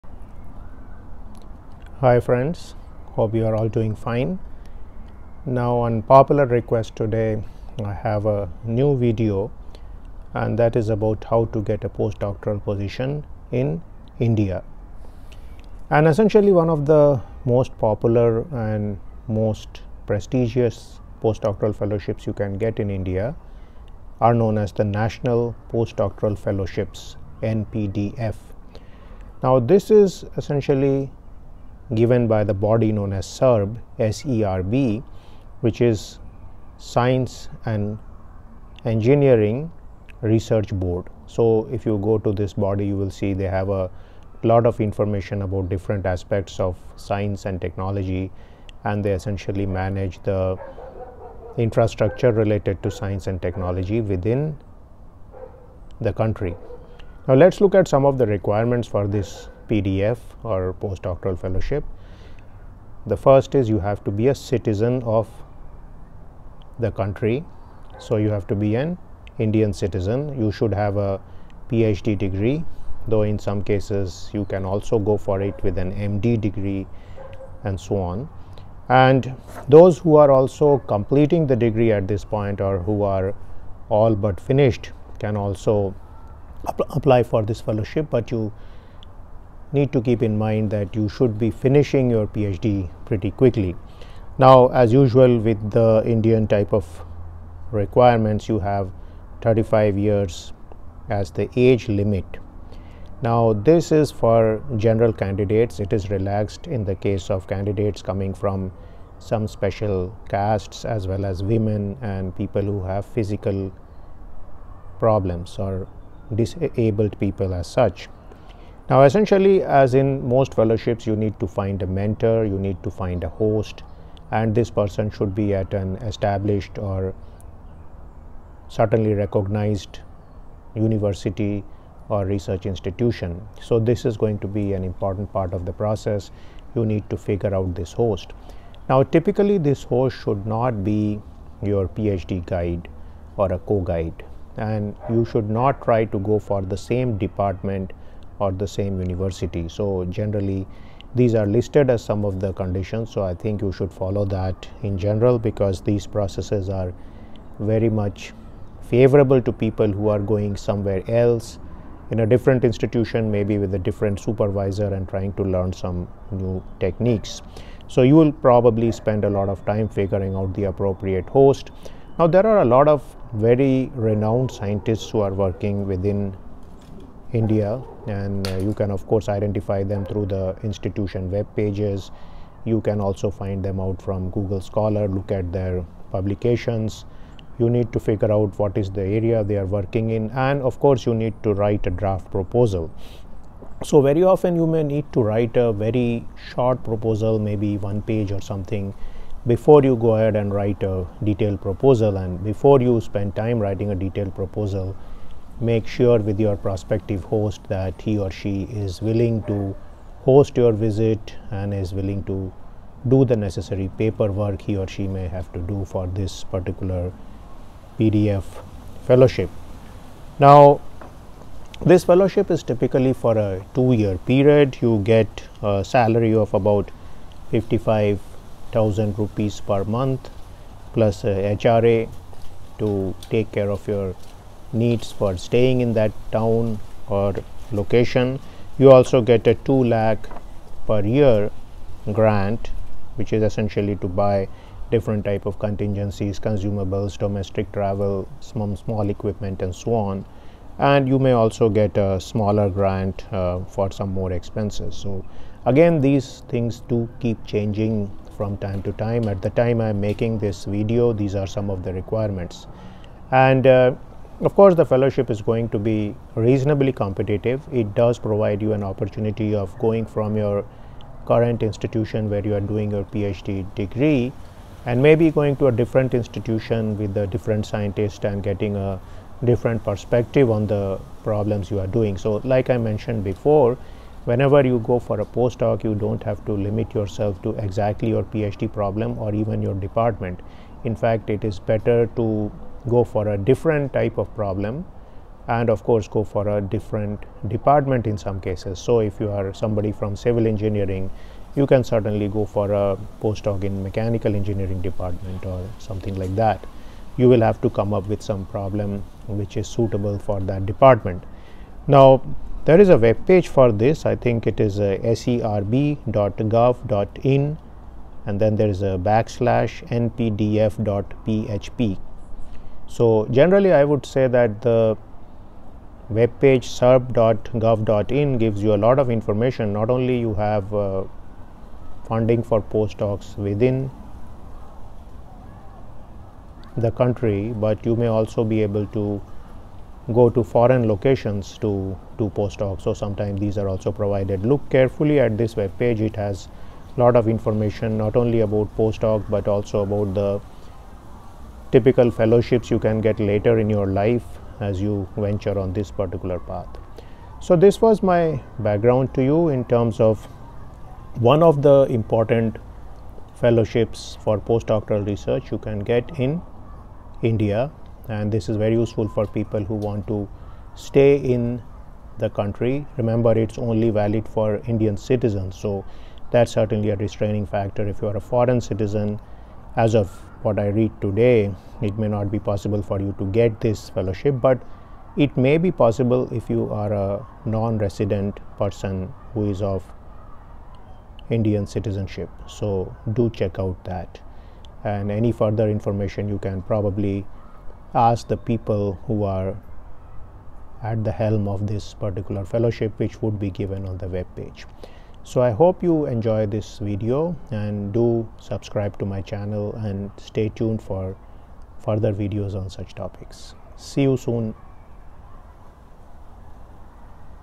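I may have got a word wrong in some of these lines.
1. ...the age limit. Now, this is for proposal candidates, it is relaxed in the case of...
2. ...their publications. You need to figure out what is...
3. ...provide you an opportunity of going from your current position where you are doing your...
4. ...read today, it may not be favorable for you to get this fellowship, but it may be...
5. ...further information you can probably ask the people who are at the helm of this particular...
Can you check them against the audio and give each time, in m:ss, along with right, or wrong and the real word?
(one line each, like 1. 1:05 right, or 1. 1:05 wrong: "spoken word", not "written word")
1. 1:41 wrong: "general", not "proposal"
2. 3:05 right
3. 4:28 wrong: "institution", not "position"
4. 6:20 wrong: "possible", not "favorable"
5. 6:35 right.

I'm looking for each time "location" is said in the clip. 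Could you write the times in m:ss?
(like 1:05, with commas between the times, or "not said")
3:57, 5:40.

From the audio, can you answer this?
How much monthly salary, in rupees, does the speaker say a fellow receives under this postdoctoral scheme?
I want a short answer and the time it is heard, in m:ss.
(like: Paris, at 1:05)
55,000 rupees, at 3:47.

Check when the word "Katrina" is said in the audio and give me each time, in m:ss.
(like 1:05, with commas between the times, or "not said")
not said.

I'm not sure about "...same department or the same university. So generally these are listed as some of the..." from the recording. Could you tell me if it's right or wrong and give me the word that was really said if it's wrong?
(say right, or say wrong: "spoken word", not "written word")
right.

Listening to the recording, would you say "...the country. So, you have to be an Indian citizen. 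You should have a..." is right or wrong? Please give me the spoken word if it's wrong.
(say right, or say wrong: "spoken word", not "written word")
right.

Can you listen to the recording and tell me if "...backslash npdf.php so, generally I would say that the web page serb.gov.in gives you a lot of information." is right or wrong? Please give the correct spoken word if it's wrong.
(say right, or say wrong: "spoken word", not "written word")
right.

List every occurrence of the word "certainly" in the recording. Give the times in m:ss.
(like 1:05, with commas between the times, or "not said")
2:08, 5:01, 6:16.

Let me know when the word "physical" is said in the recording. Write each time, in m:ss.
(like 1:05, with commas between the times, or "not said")
1:53.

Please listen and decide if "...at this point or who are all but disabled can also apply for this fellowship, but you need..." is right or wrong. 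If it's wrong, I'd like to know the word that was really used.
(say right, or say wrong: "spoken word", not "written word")
wrong: "finished", not "disabled".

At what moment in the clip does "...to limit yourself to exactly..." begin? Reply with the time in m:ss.
4:46.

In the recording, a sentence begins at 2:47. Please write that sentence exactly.
So you will probably spend a lot of time figuring out the appropriate host.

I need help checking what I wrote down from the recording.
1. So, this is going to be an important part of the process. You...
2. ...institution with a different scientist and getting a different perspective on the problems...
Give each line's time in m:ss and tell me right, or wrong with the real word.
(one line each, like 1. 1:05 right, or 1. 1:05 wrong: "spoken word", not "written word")
1. 2:13 right
2. 4:36 right.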